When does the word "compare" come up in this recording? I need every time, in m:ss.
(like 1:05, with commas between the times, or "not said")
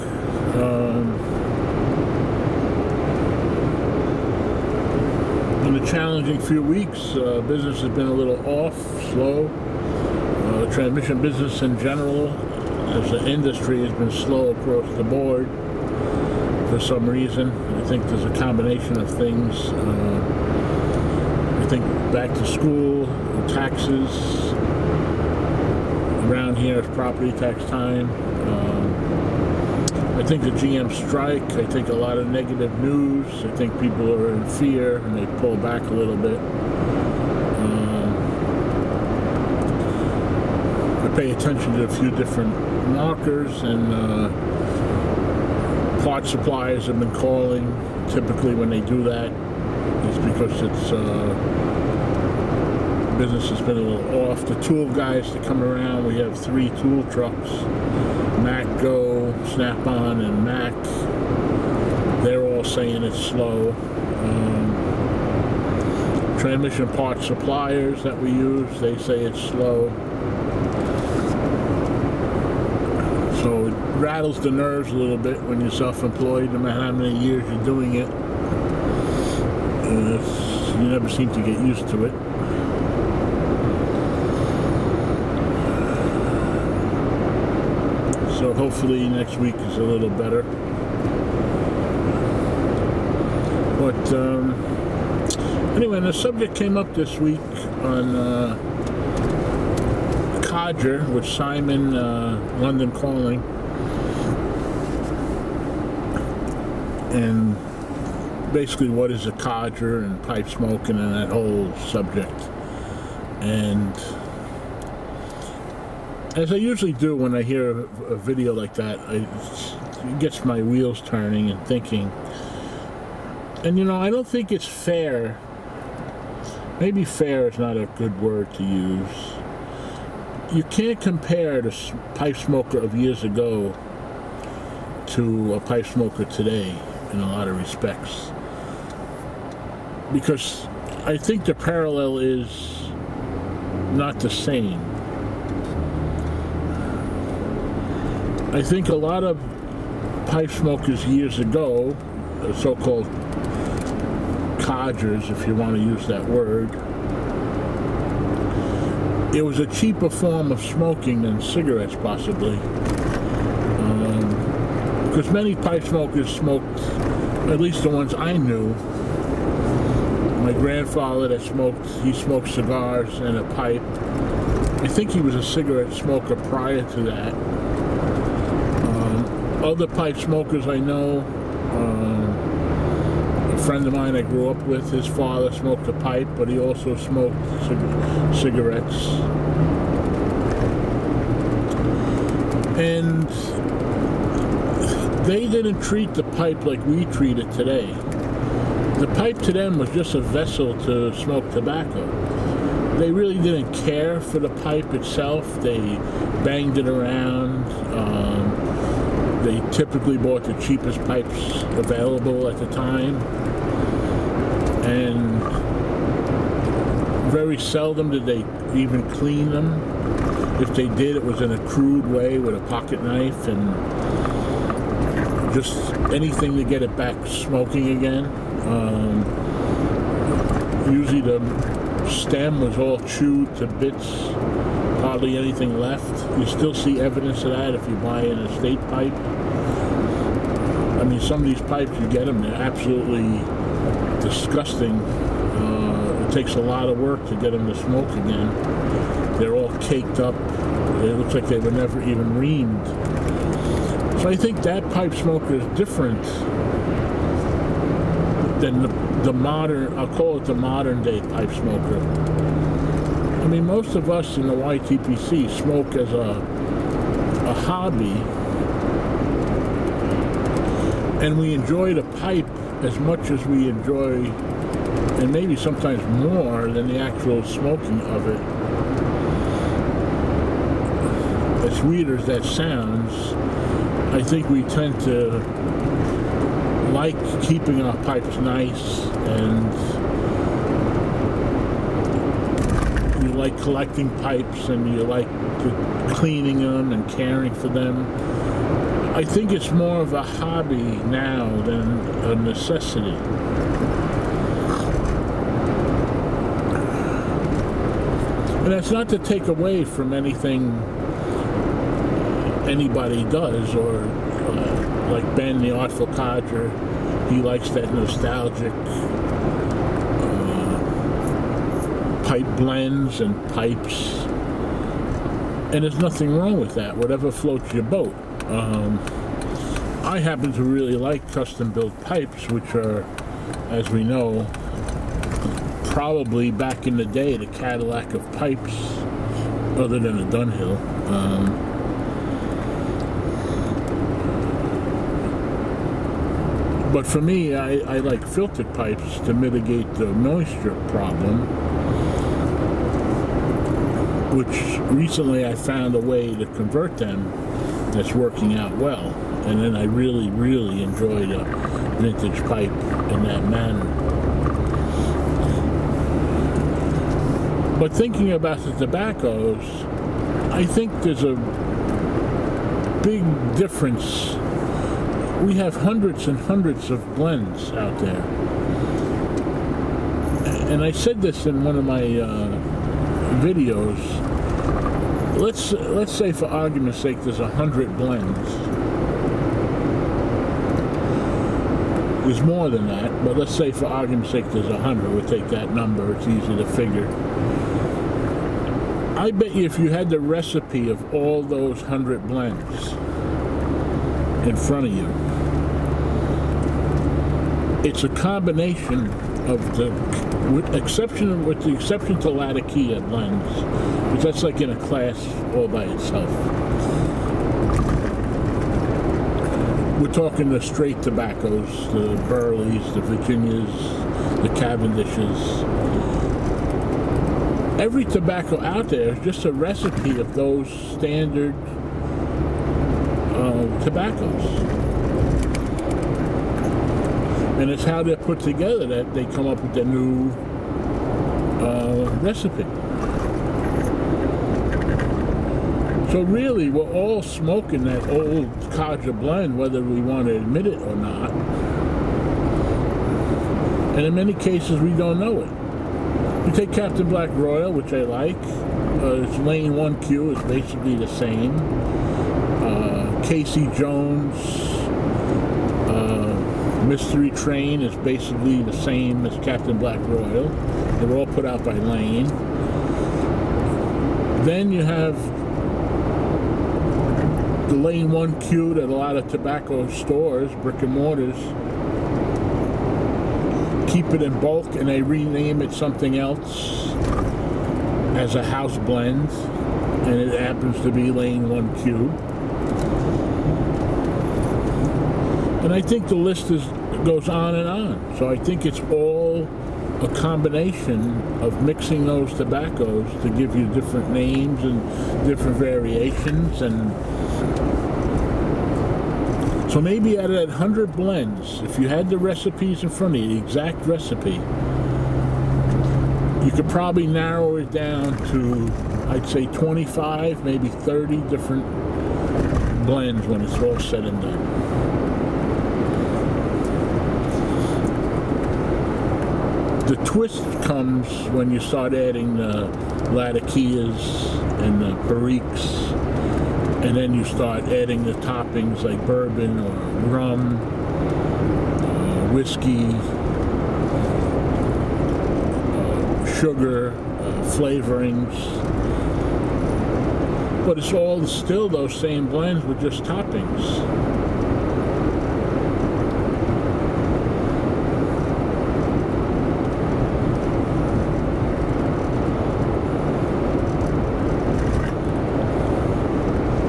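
2:11.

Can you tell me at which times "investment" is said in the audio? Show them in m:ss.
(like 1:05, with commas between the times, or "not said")
not said.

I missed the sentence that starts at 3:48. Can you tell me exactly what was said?
Um, usually the stem was all chewed to bits, hardly anything left.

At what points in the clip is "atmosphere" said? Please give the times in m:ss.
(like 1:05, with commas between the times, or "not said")
not said.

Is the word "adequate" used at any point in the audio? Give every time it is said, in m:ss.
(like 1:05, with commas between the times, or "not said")
not said.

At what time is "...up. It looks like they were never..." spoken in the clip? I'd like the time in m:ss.
4:10.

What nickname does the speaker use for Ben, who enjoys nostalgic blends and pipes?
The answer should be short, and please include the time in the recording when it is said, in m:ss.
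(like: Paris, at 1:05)
the Artful Codger, at 5:15.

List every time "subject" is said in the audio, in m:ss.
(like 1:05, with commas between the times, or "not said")
1:36, 1:51.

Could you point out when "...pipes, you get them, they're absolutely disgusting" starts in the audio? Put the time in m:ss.
4:01.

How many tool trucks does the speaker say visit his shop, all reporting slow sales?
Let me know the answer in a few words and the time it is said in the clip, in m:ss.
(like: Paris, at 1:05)
3, at 0:56.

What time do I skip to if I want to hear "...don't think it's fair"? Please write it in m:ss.
2:04.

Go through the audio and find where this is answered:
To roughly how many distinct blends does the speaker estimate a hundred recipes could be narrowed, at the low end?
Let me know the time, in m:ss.
8:39.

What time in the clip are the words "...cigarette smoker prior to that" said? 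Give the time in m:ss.
2:55.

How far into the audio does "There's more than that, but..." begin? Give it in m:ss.
6:32.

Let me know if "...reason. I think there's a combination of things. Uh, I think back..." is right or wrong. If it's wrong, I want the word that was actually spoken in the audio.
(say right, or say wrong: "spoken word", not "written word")
right.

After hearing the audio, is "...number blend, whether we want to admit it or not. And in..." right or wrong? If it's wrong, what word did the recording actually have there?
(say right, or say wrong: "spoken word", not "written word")
wrong: "codger", not "number".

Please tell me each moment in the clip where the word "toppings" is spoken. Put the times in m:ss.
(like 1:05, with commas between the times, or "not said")
8:58, 9:13.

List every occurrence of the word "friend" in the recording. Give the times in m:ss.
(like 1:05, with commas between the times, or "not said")
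3:03.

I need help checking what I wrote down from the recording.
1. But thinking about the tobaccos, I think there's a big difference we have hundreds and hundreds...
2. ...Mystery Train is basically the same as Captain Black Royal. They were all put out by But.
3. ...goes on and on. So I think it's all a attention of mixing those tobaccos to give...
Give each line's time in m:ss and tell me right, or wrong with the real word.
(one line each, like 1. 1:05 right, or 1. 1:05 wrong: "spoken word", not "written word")
1. 6:07 right
2. 7:46 wrong: "Lane", not "But"
3. 8:17 wrong: "combination", not "attention".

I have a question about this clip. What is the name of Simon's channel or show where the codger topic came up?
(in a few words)
London Calling.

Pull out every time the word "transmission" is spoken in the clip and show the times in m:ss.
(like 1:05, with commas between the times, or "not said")
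0:10, 1:06.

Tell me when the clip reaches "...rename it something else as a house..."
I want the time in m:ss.
8:05.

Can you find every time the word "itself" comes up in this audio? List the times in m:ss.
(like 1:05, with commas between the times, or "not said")
3:24, 6:55.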